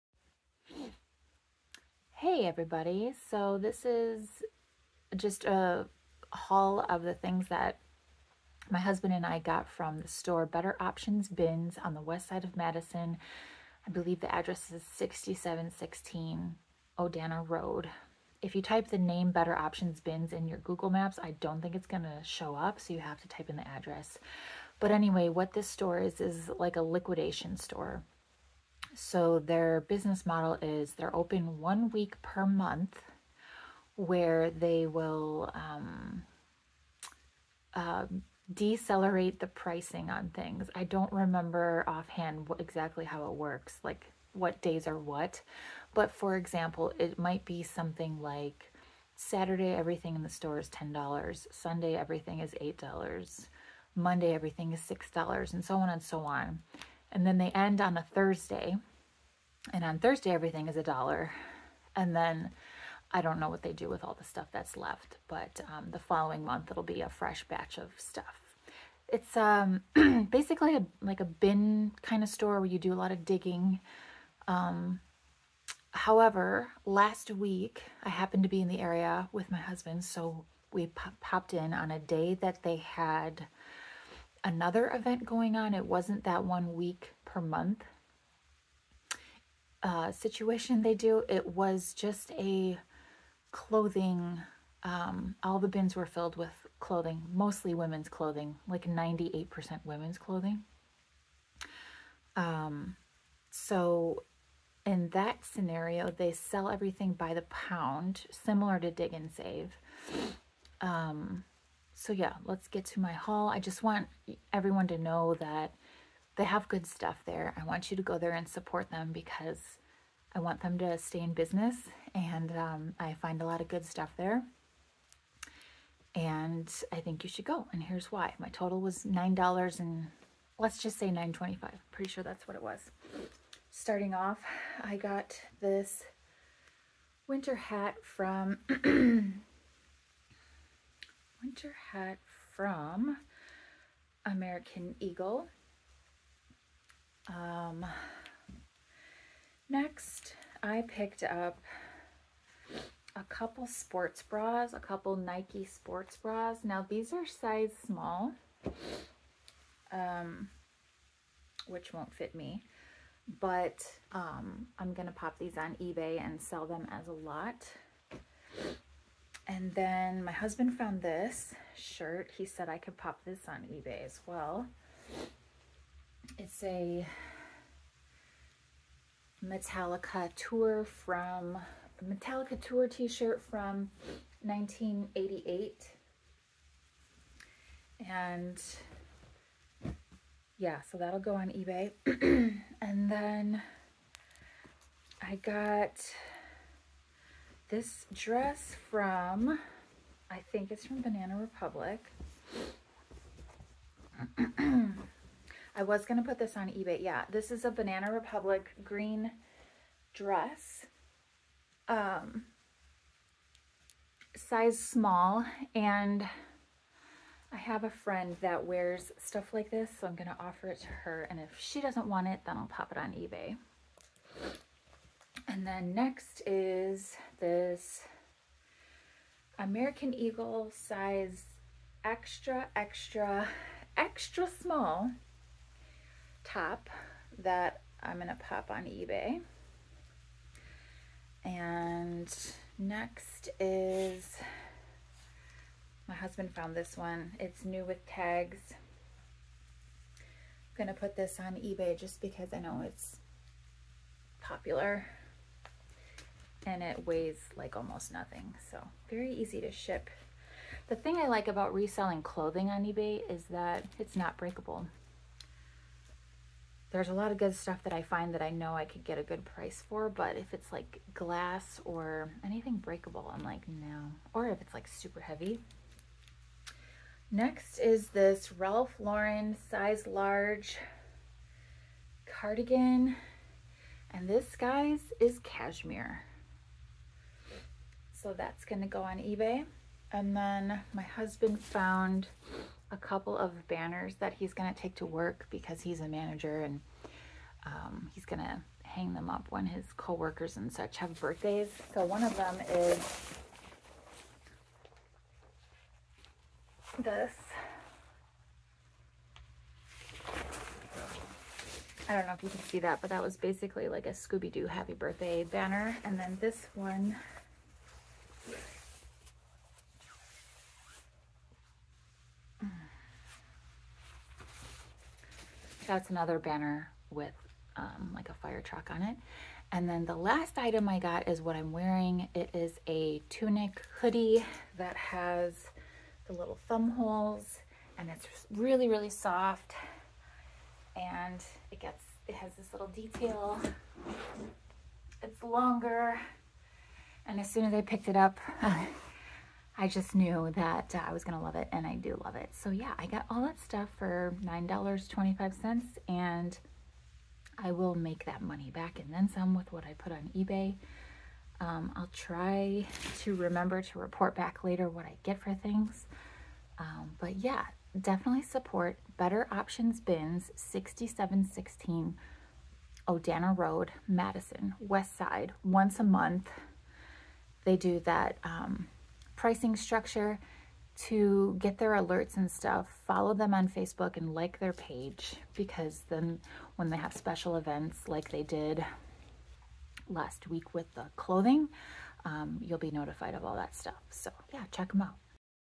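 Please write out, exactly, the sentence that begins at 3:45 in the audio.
And then next is this American Eagle size extra, extra, extra small top that I'm going to pop on eBay.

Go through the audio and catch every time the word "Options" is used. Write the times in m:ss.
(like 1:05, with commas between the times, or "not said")
0:10, 0:19, 6:09.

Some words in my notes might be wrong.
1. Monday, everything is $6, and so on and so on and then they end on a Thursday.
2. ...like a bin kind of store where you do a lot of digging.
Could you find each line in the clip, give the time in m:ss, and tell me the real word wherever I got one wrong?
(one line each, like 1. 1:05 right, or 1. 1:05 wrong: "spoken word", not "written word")
1. 0:53 right
2. 1:11 right.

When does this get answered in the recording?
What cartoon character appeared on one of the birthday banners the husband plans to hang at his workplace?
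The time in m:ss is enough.
5:14.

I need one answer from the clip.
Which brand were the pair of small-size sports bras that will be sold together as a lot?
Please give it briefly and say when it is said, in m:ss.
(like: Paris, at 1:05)
Nike, at 2:35.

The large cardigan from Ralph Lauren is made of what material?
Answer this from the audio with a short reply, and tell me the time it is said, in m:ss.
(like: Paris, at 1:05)
Cashmere, at 4:45.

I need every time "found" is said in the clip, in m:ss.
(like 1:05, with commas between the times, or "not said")
2:50, 4:06, 4:51.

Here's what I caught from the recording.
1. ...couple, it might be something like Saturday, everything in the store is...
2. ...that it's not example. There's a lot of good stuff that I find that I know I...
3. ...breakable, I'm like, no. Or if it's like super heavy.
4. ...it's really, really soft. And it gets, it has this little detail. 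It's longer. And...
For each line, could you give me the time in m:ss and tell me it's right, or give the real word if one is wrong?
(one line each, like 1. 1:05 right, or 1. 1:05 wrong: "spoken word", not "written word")
1. 0:46 wrong: "example", not "couple"
2. 4:23 wrong: "breakable", not "example"
3. 4:32 right
4. 5:38 right.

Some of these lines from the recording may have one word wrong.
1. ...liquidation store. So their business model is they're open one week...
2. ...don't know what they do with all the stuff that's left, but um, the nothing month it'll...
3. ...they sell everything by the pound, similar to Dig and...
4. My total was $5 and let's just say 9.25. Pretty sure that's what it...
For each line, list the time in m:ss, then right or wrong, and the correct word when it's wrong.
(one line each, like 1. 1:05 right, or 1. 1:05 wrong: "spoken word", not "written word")
1. 0:26 right
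2. 1:03 wrong: "following", not "nothing"
3. 1:46 right
4. 2:08 wrong: "9", not "5".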